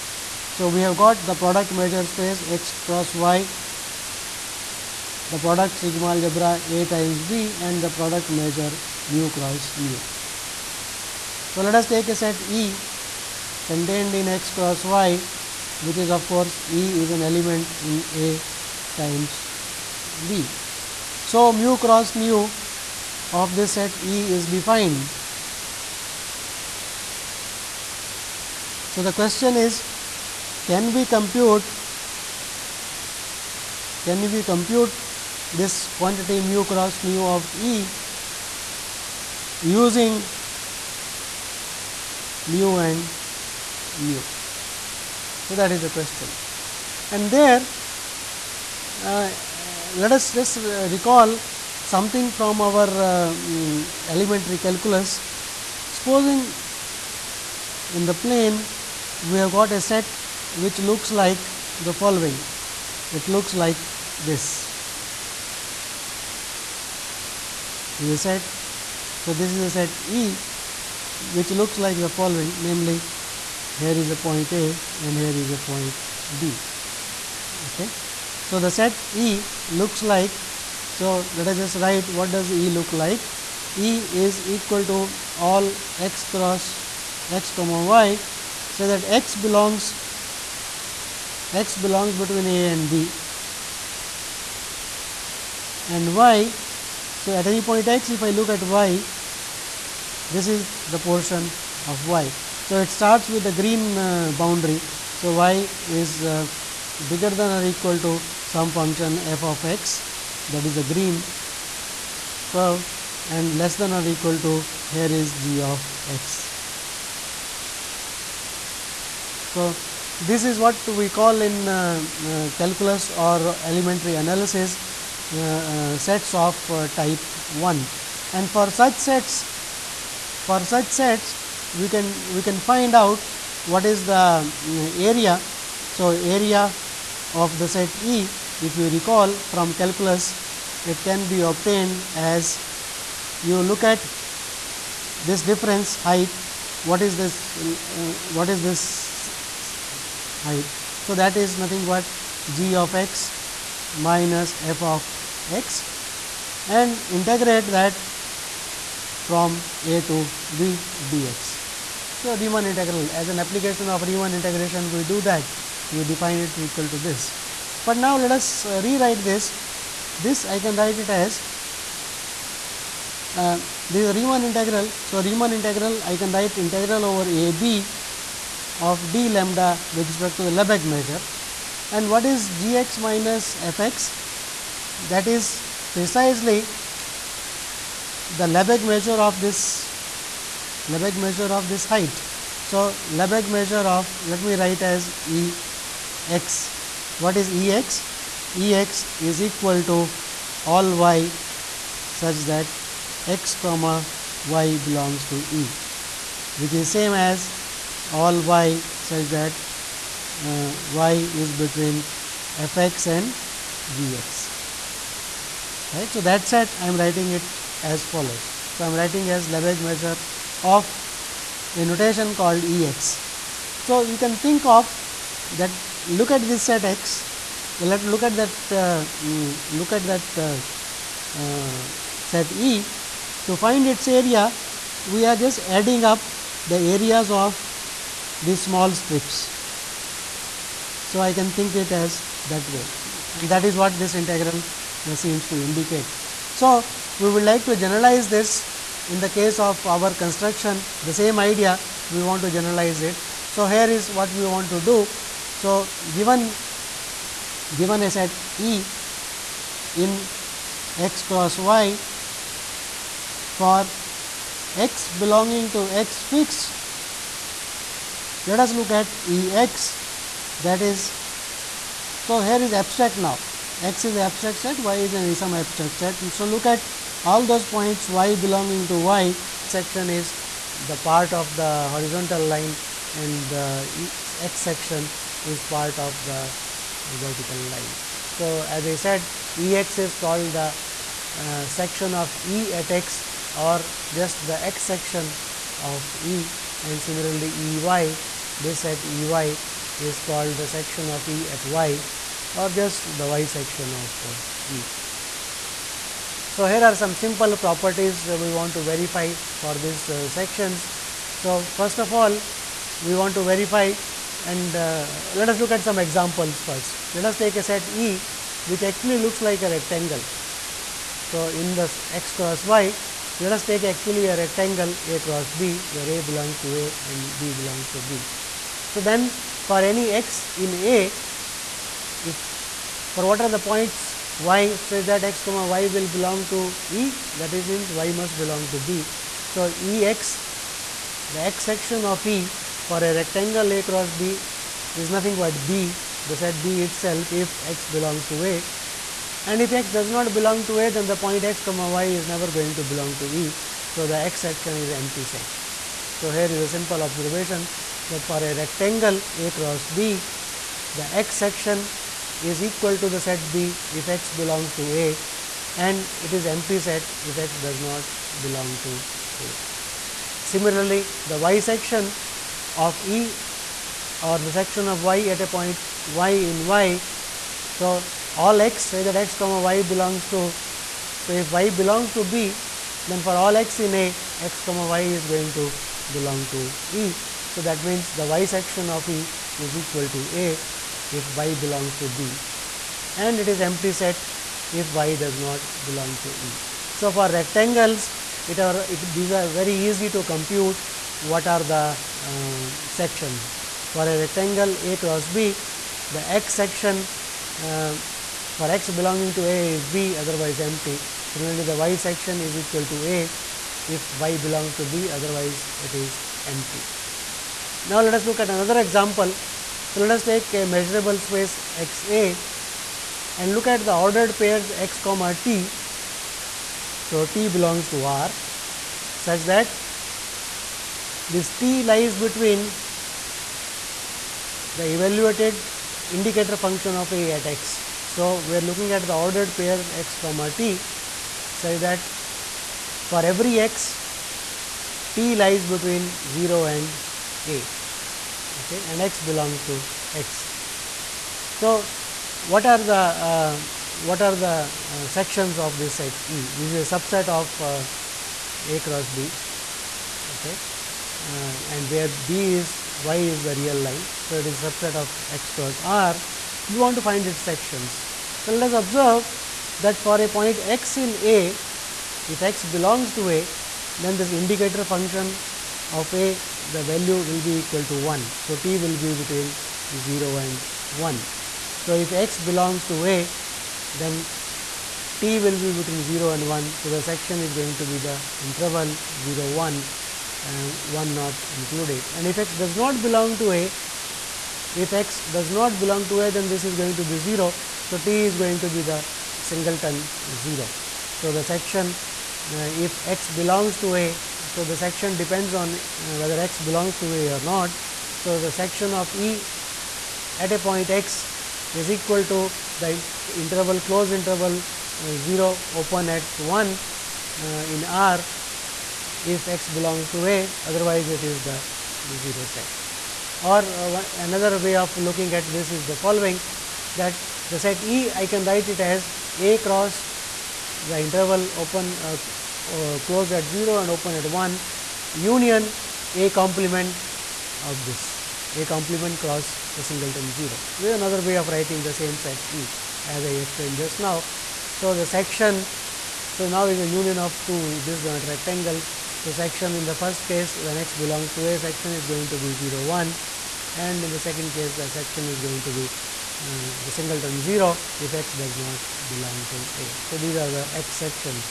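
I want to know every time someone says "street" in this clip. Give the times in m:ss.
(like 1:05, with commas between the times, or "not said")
not said.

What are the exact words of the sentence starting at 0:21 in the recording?
So, mu cross nu of this set E is defined.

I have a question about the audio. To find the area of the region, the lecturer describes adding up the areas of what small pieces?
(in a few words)
small strips.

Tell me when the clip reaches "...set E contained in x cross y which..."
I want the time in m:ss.
0:12.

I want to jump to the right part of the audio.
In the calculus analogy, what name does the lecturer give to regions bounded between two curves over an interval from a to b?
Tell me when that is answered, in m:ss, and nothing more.
2:05.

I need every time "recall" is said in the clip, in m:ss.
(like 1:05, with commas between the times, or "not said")
0:50, 2:18.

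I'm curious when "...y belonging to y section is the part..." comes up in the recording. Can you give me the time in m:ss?
4:38.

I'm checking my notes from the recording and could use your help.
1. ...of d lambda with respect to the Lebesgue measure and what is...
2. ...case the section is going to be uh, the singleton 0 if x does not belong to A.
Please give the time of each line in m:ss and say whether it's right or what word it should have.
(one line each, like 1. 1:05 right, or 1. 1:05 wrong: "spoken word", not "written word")
1. 2:58 right
2. 9:14 right.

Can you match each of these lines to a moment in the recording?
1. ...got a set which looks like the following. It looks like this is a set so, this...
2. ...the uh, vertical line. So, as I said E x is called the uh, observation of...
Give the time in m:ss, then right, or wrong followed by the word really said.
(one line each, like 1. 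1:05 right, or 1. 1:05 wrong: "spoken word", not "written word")
1. 0:59 right
2. 4:46 wrong: "section", not "observation".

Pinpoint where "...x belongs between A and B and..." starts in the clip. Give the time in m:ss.
1:31.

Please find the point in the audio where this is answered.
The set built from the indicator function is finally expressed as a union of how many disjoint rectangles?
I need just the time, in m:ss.
9:07.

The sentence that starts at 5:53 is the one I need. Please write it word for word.
So, the x section is empty set.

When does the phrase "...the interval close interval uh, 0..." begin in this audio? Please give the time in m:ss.
8:32.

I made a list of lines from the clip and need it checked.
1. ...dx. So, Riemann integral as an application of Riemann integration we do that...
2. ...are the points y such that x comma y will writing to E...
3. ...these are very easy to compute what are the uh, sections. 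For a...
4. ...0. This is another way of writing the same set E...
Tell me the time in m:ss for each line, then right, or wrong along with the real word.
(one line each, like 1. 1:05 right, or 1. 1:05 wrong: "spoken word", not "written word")
1. 2:41 right
2. 5:33 wrong: "belong", not "writing"
3. 6:39 right
4. 9:00 right.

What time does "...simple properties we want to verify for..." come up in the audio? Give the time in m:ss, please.
5:07.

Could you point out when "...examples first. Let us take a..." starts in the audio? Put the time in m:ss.
5:15.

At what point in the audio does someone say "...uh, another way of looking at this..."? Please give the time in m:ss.
8:43.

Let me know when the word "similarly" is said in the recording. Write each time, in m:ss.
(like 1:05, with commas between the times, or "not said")
4:56, 6:10, 6:51.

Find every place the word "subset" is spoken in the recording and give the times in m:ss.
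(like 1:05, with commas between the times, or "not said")
7:36, 7:44.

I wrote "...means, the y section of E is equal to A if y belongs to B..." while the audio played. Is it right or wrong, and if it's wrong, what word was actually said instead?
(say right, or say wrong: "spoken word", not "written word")
right.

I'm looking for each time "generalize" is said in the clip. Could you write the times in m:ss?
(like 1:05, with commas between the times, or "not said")
4:07, 4:12.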